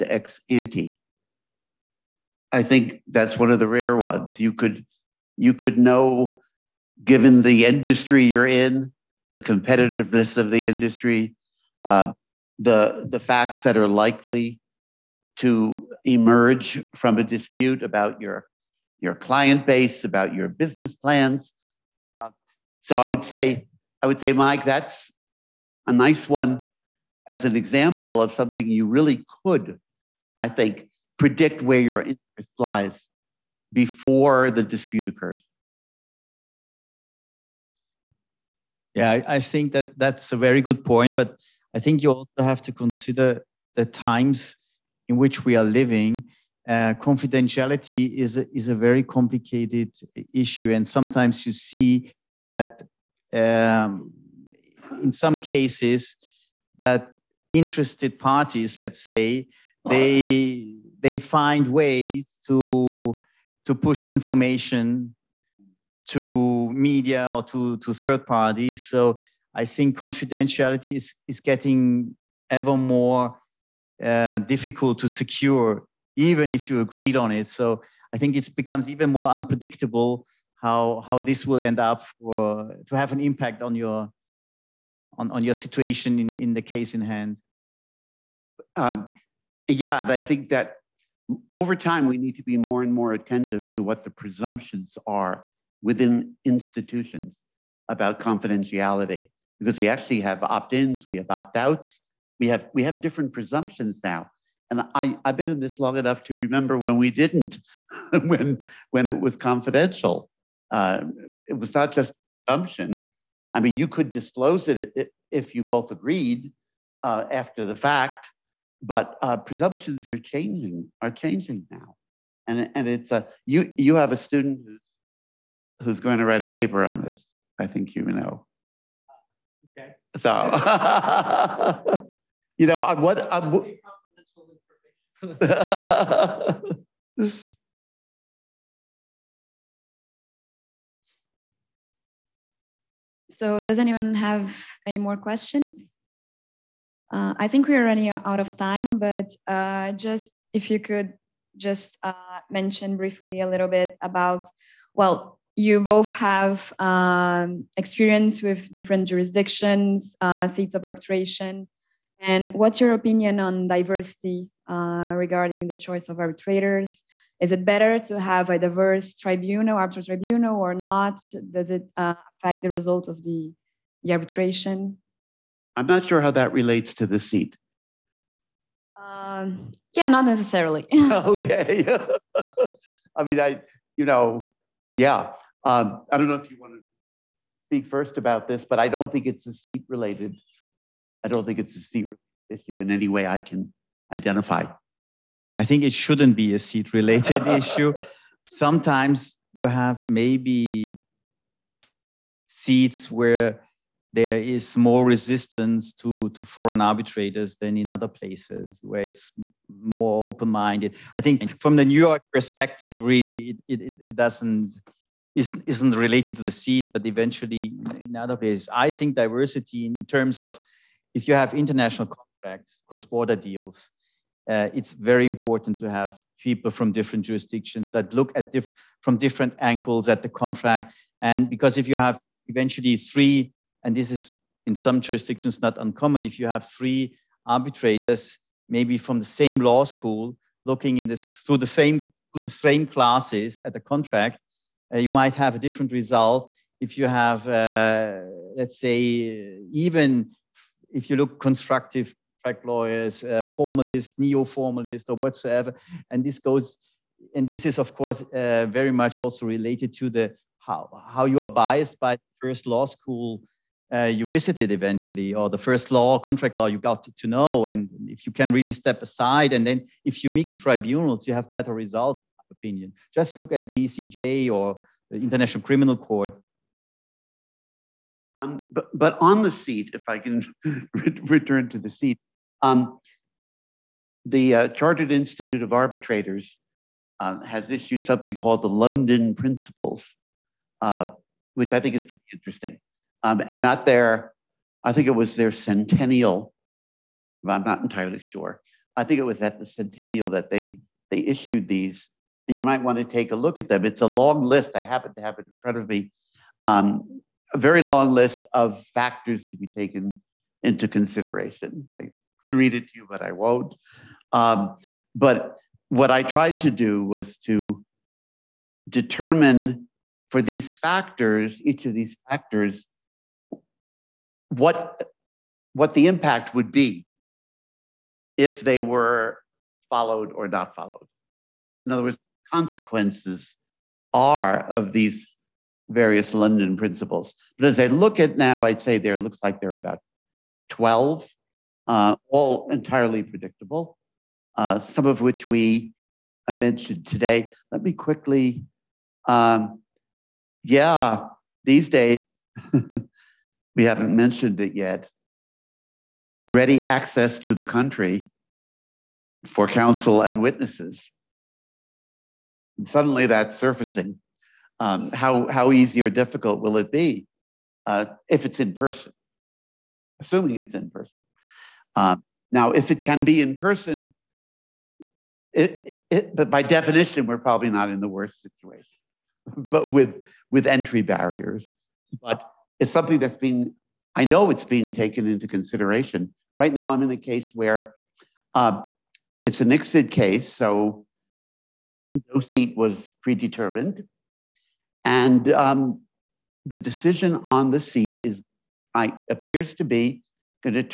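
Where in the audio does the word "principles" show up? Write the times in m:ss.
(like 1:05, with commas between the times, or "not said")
4:49, 5:36.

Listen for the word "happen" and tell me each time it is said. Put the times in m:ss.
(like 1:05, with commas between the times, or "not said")
5:04.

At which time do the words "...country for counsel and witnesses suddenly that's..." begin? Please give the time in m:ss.
5:57.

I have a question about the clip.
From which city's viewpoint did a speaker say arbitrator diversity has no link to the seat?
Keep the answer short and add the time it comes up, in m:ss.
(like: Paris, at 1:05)
New York, at 3:31.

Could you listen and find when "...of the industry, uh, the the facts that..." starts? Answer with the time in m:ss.
0:10.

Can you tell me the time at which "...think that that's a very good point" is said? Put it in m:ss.
0:39.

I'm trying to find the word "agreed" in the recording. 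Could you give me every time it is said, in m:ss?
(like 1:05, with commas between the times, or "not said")
1:16, 1:55.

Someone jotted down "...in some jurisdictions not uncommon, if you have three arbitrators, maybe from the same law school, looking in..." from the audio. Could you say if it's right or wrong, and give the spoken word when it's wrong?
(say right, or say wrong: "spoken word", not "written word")
right.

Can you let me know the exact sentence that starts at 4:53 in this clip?
Um, and at their, I think it was their centennial, I'm not entirely sure.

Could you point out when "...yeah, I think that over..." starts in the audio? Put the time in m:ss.
1:29.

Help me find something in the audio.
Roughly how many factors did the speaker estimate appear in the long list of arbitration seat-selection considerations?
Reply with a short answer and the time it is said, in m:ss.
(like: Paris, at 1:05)
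12, at 5:40.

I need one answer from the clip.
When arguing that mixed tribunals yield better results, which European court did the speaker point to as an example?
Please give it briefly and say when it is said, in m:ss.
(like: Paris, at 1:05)
ECJ, at 4:33.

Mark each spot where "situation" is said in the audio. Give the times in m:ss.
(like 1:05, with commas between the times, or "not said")
1:25, 6:18.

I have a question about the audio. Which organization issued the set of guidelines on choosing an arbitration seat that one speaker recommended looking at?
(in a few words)
Chartered Institute of Arbitrators.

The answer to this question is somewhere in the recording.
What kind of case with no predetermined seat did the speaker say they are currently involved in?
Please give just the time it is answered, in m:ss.
6:29.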